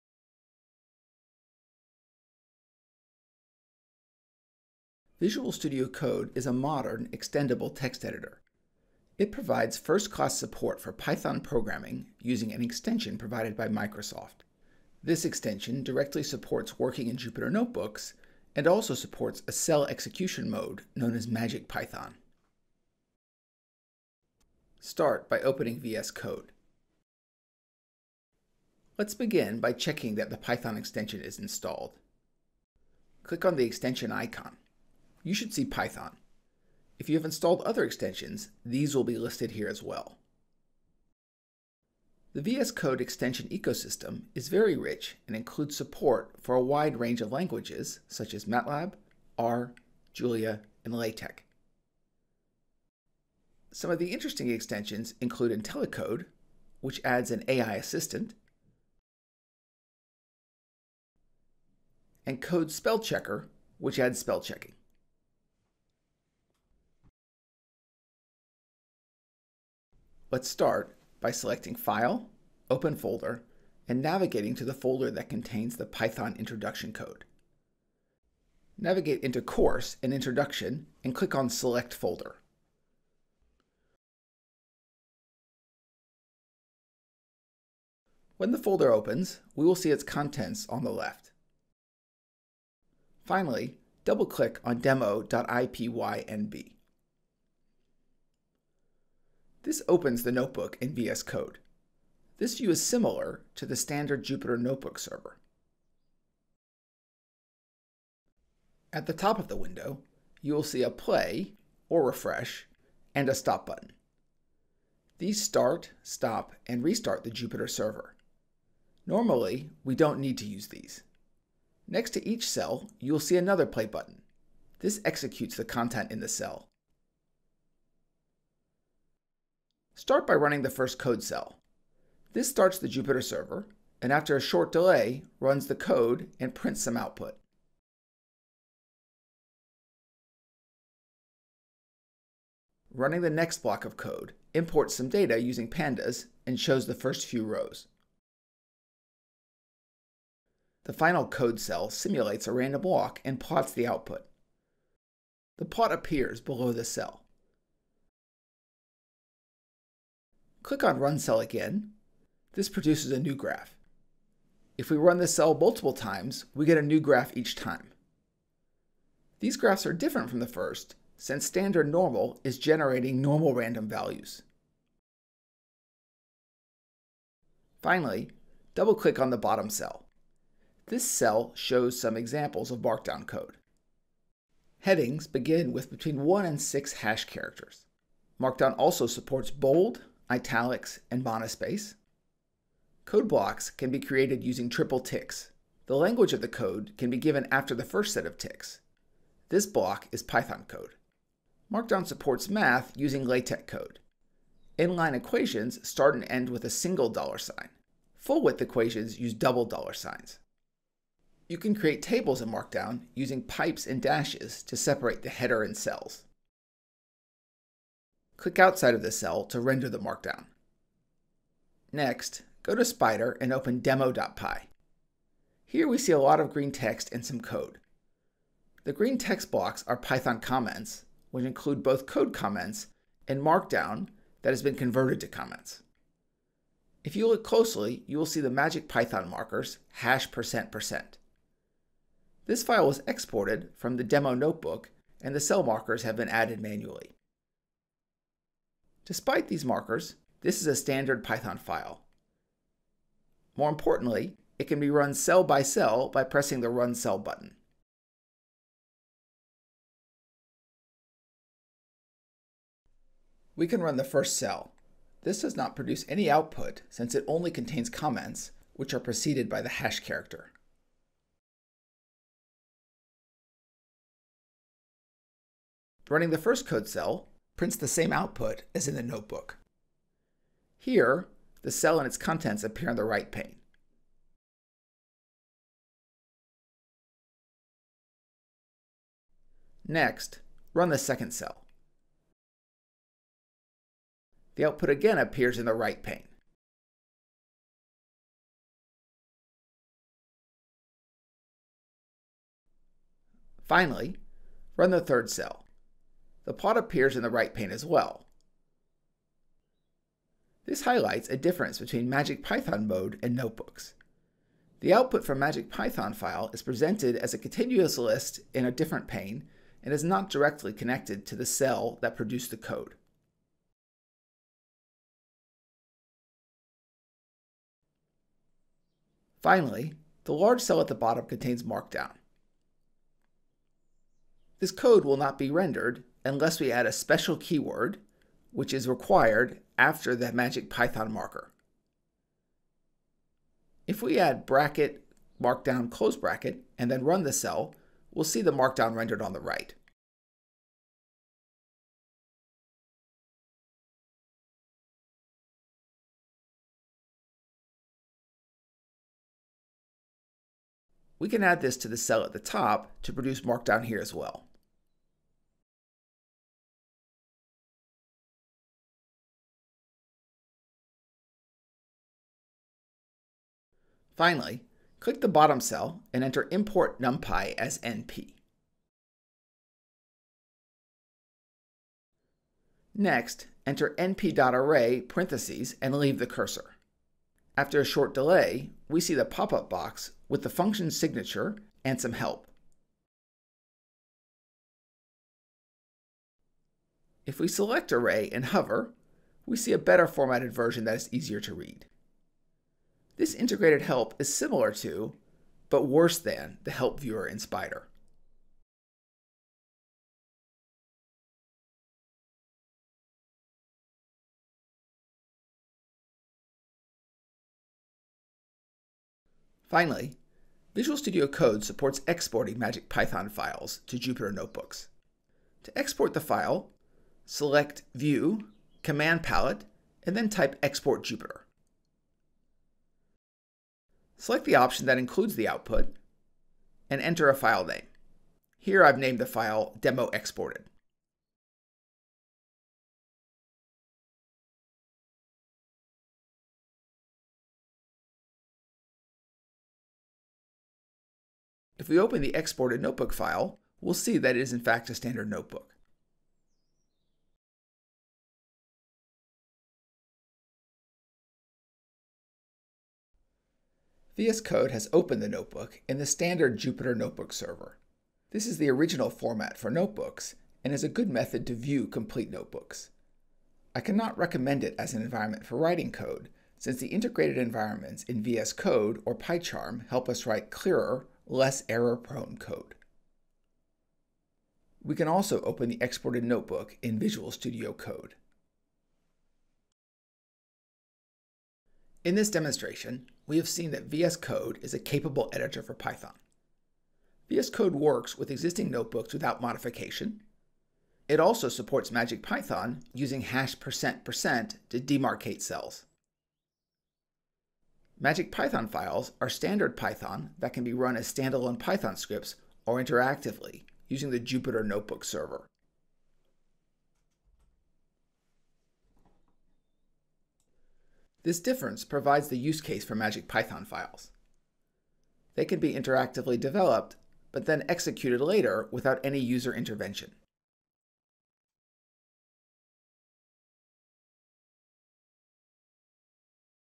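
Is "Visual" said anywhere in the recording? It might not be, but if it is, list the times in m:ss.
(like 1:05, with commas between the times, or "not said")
0:05, 7:00, 8:06.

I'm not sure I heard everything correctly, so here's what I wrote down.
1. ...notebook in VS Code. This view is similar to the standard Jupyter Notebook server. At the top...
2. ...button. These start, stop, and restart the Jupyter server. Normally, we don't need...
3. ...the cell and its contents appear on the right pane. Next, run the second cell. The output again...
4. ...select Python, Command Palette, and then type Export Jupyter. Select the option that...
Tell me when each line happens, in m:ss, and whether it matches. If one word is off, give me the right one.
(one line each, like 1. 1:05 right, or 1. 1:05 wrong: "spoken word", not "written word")
1. 1:40 right
2. 1:53 right
3. 4:41 right
4. 7:07 wrong: "View", not "Python".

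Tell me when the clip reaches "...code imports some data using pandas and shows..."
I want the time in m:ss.
2:23.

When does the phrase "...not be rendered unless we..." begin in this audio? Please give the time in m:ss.
5:35.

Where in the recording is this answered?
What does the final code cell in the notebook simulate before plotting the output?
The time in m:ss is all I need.
2:32.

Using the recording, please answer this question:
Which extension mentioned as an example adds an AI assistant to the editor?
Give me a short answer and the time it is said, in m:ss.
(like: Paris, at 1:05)
IntelliCode, at 0:55.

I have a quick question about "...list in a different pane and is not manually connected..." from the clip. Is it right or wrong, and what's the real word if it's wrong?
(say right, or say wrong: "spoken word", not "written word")
wrong: "directly", not "manually".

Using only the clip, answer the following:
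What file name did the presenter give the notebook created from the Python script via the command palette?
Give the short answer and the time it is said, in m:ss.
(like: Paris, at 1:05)
demo exported, at 7:19.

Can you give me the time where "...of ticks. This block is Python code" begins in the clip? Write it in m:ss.
3:18.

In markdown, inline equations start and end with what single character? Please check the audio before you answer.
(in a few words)
Dollar sign.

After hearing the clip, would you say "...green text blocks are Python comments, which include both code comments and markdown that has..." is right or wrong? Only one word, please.
right.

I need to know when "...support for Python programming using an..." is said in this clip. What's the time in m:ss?
0:10.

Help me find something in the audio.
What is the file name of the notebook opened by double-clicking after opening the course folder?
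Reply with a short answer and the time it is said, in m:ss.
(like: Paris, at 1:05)
demo.ipynb, at 1:34.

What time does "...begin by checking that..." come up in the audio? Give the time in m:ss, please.
0:29.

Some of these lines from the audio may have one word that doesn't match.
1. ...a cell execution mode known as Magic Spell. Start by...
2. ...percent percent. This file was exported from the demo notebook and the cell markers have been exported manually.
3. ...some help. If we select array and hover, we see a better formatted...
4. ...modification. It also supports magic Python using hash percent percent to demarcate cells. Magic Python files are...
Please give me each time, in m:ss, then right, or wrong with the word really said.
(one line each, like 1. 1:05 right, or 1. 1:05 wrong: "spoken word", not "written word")
1. 0:19 wrong: "Python", not "Spell"
2. 4:00 wrong: "added", not "exported"
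3. 6:31 right
4. 8:19 right.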